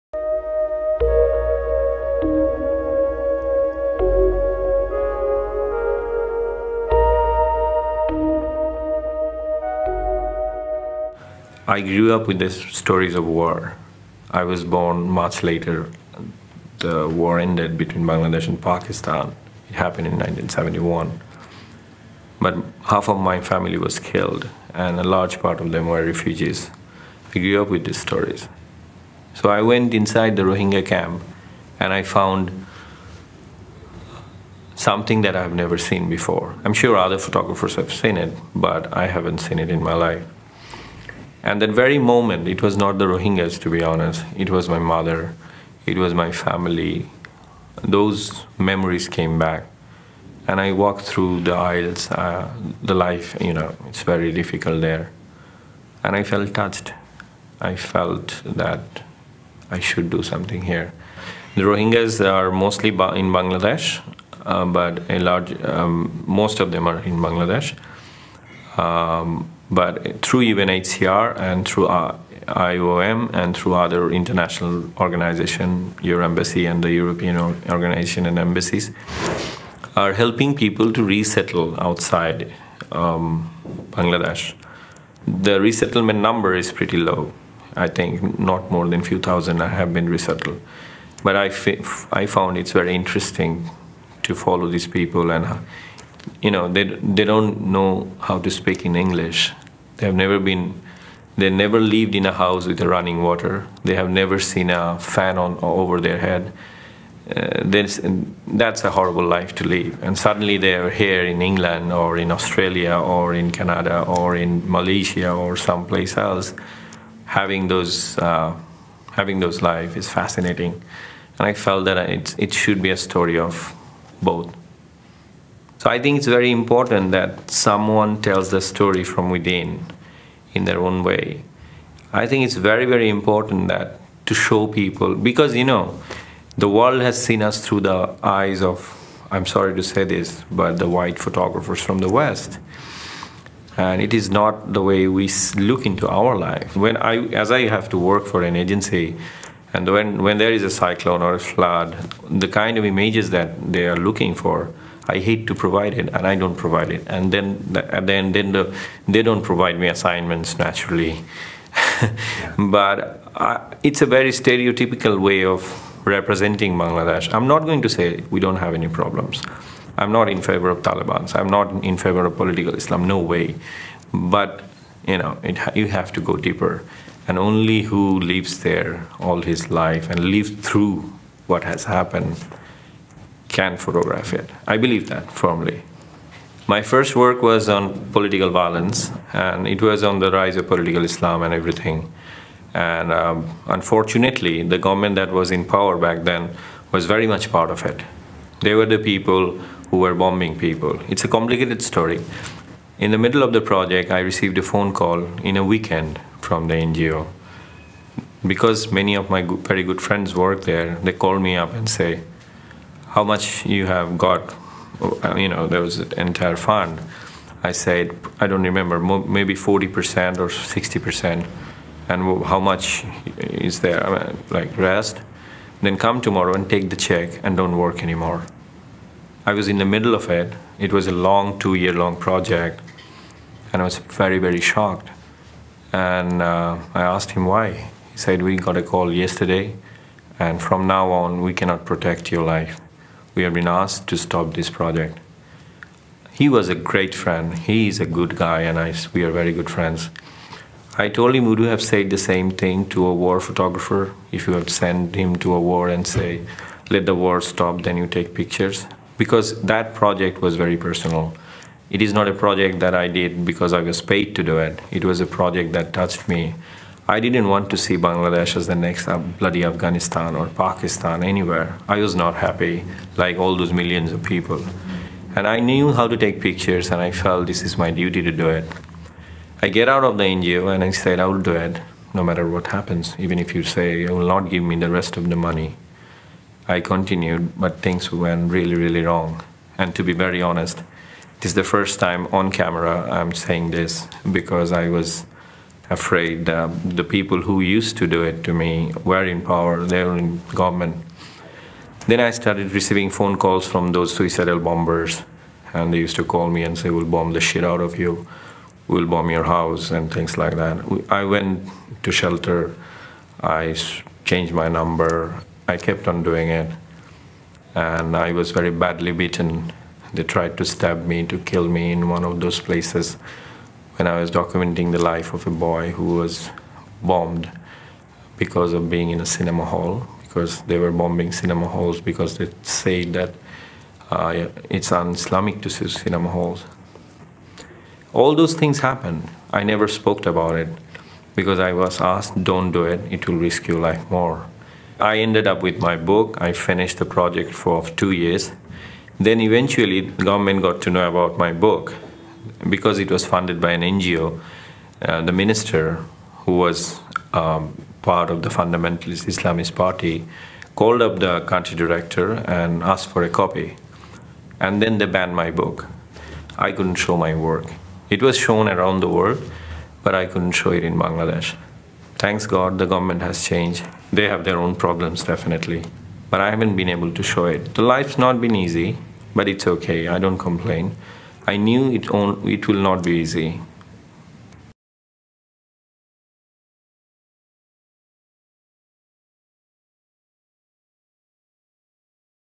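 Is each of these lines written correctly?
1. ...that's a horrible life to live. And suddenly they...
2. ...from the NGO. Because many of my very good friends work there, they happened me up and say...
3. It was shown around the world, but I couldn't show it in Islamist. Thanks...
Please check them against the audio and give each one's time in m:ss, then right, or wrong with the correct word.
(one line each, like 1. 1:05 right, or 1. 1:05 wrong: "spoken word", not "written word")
1. 1:48 right
2. 3:26 wrong: "called", not "happened"
3. 6:08 wrong: "Bangladesh", not "Islamist".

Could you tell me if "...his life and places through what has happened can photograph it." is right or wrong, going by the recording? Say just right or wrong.
wrong.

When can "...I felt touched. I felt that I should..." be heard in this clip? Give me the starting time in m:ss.
0:56.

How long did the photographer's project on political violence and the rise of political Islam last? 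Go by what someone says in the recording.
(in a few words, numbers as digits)
Two years.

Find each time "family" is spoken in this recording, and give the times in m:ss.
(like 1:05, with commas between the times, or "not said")
0:23, 0:46.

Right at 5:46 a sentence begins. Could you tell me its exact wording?
I finished the project for two years.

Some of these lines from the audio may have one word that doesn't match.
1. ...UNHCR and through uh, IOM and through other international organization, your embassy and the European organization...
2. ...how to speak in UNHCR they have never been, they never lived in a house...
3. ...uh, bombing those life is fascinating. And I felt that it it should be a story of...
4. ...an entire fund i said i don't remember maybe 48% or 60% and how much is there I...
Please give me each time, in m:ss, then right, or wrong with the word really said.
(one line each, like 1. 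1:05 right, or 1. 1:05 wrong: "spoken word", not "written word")
1. 1:10 right
2. 1:38 wrong: "English", not "UNHCR"
3. 1:58 wrong: "having", not "bombing"
4. 3:35 wrong: "40", not "48".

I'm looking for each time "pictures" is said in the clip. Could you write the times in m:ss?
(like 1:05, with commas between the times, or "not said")
4:18, 4:36.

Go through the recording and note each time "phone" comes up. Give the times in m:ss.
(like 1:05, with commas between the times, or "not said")
3:24, 5:03.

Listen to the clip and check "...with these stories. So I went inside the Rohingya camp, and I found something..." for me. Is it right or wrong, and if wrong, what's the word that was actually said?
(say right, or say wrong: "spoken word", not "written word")
right.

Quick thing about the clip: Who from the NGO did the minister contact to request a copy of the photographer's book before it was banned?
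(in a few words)
The country director.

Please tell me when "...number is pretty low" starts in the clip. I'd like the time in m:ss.
1:26.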